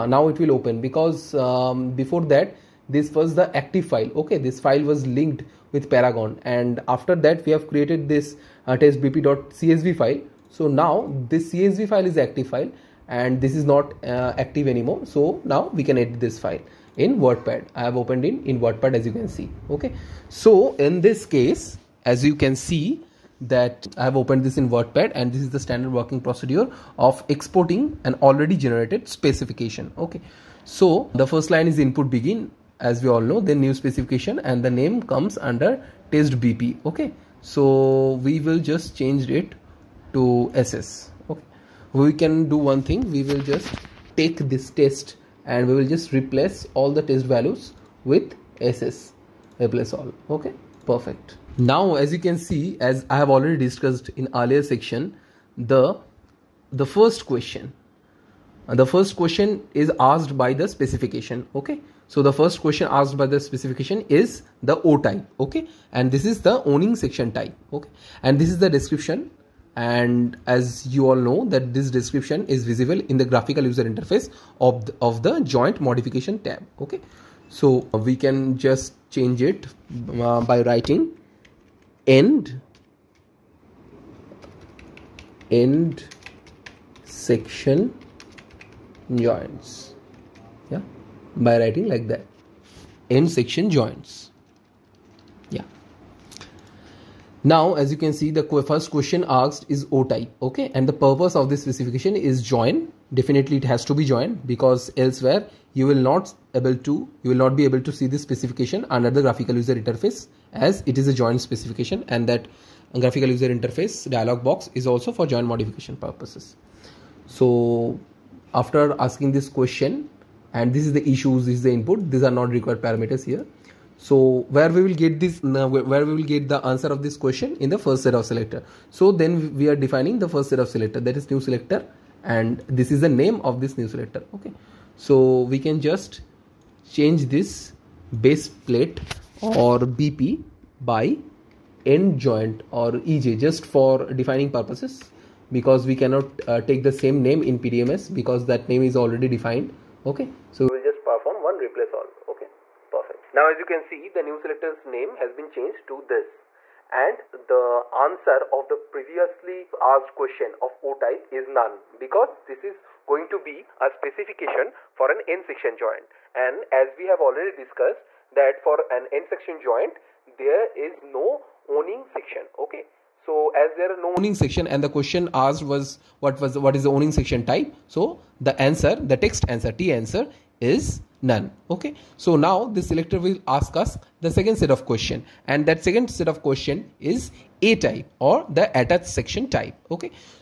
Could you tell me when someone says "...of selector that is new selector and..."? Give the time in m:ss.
2:10.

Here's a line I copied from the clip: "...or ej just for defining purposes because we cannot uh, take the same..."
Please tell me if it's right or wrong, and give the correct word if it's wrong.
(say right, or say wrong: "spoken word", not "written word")
right.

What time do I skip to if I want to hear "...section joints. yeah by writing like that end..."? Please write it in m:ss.
1:27.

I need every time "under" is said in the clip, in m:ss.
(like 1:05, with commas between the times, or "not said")
0:35, 1:48.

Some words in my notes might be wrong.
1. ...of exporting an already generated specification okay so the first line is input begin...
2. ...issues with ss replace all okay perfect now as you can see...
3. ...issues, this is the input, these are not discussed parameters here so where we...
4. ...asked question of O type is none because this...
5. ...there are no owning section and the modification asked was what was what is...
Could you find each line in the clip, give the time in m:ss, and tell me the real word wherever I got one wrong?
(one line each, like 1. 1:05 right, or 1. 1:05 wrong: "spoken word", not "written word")
1. 0:26 right
2. 0:47 wrong: "values", not "issues"
3. 2:01 wrong: "required", not "discussed"
4. 2:39 right
5. 2:53 wrong: "question", not "modification".